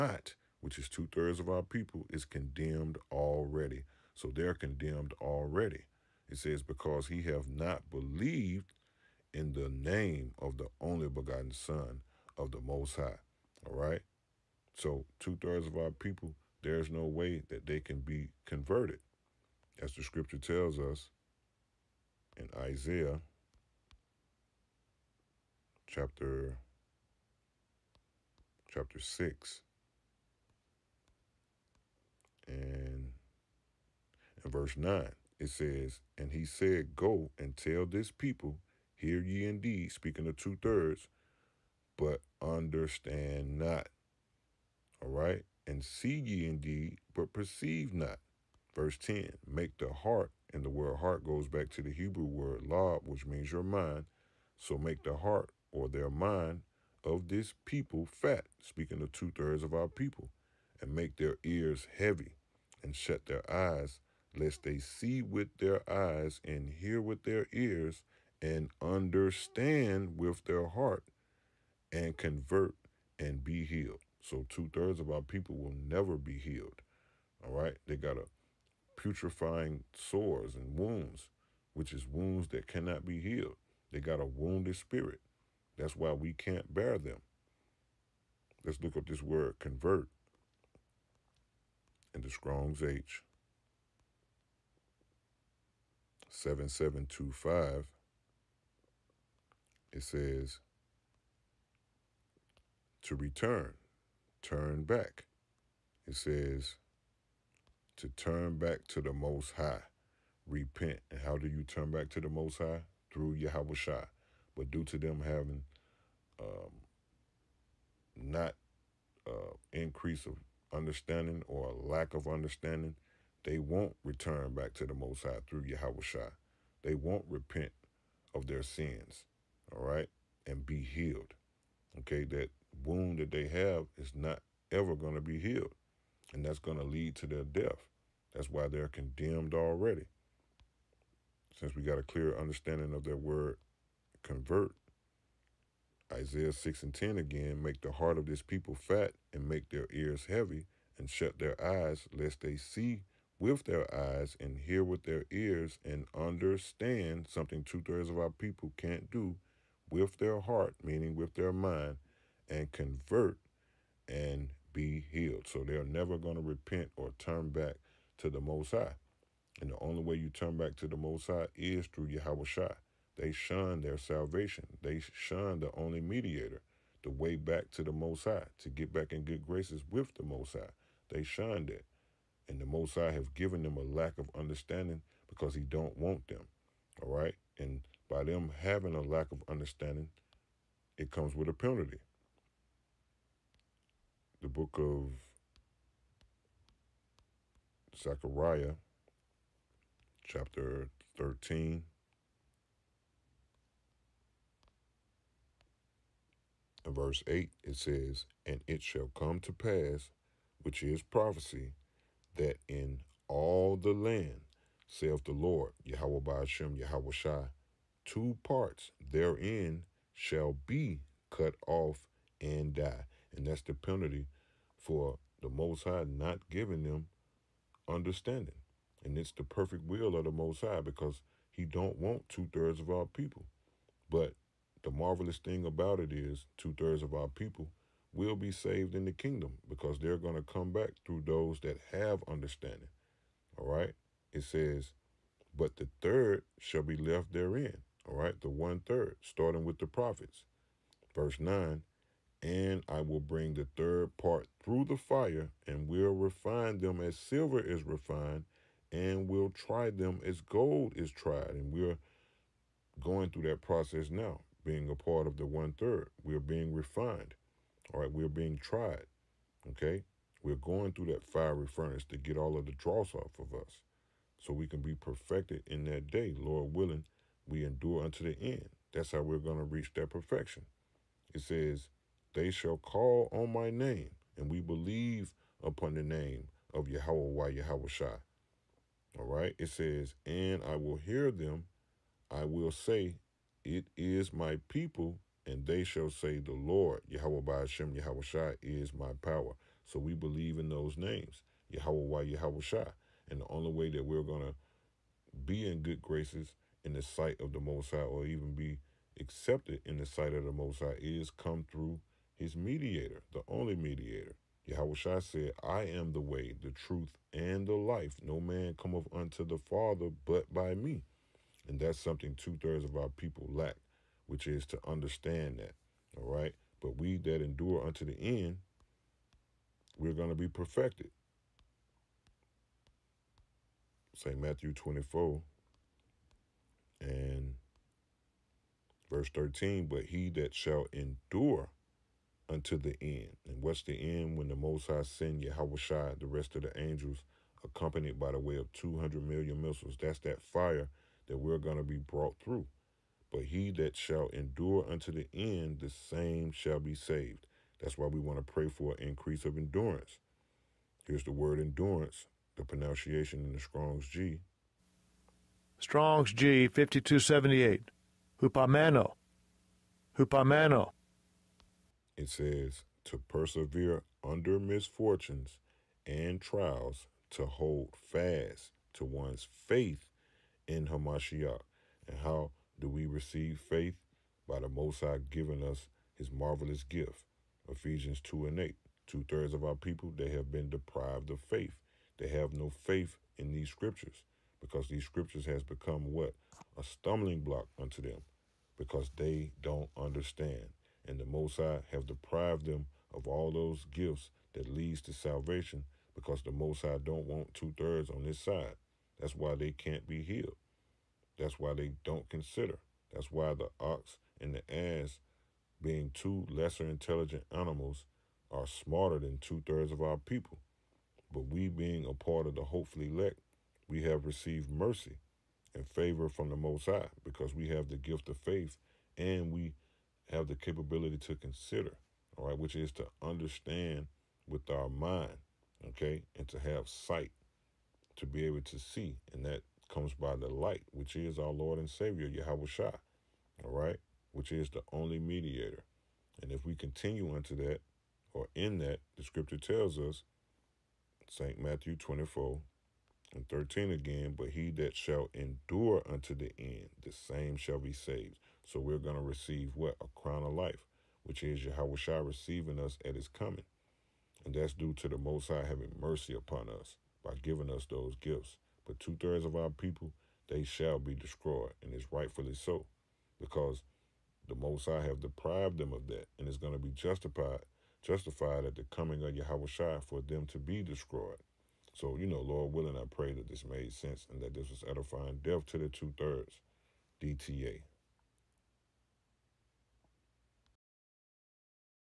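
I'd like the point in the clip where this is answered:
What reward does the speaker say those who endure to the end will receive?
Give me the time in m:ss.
7:40.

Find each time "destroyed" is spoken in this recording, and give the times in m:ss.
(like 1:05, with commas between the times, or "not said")
7:51, 8:00.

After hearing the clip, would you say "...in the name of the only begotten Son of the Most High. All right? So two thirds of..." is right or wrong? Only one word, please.
right.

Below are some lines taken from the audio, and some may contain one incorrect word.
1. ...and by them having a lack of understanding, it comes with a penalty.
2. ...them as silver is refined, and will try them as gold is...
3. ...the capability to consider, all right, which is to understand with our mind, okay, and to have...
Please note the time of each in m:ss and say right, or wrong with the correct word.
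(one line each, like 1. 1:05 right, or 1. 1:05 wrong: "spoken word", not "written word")
1. 3:07 right
2. 4:16 right
3. 7:10 right.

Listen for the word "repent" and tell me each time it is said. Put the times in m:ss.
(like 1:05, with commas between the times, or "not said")
1:50, 2:07, 2:46.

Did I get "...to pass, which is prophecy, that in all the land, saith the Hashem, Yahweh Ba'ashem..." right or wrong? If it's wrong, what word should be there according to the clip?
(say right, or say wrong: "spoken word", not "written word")
wrong: "Lord", not "Hashem".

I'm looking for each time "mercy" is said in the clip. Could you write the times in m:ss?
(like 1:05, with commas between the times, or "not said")
7:04, 7:45.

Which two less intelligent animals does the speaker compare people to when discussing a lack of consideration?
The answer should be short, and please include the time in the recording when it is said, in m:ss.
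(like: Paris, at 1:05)
the ox and the ass, at 6:53.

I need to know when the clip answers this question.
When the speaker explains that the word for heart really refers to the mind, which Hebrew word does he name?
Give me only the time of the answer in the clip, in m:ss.
0:52.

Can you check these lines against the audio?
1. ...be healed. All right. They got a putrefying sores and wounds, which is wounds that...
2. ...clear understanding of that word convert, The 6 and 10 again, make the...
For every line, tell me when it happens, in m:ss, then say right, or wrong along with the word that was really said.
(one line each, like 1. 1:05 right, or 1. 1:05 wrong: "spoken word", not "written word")
1. 1:16 right
2. 2:22 wrong: "Isaiah", not "The".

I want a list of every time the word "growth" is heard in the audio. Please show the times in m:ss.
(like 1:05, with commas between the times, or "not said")
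not said.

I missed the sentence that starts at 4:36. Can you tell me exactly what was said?
Lord willing, we endure unto the end.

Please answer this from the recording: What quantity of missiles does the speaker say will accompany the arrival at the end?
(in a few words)
200 million.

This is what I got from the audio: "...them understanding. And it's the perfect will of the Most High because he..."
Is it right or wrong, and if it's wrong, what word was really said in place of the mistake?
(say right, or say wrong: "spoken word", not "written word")
right.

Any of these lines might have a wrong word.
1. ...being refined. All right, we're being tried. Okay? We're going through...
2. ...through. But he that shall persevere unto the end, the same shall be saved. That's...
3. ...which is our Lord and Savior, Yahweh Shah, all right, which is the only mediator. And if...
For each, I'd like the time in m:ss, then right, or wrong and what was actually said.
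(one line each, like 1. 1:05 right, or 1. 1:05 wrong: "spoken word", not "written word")
1. 4:26 right
2. 5:52 wrong: "endure", not "persevere"
3. 7:20 right.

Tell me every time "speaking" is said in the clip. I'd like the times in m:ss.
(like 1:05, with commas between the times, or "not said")
0:39, 0:58.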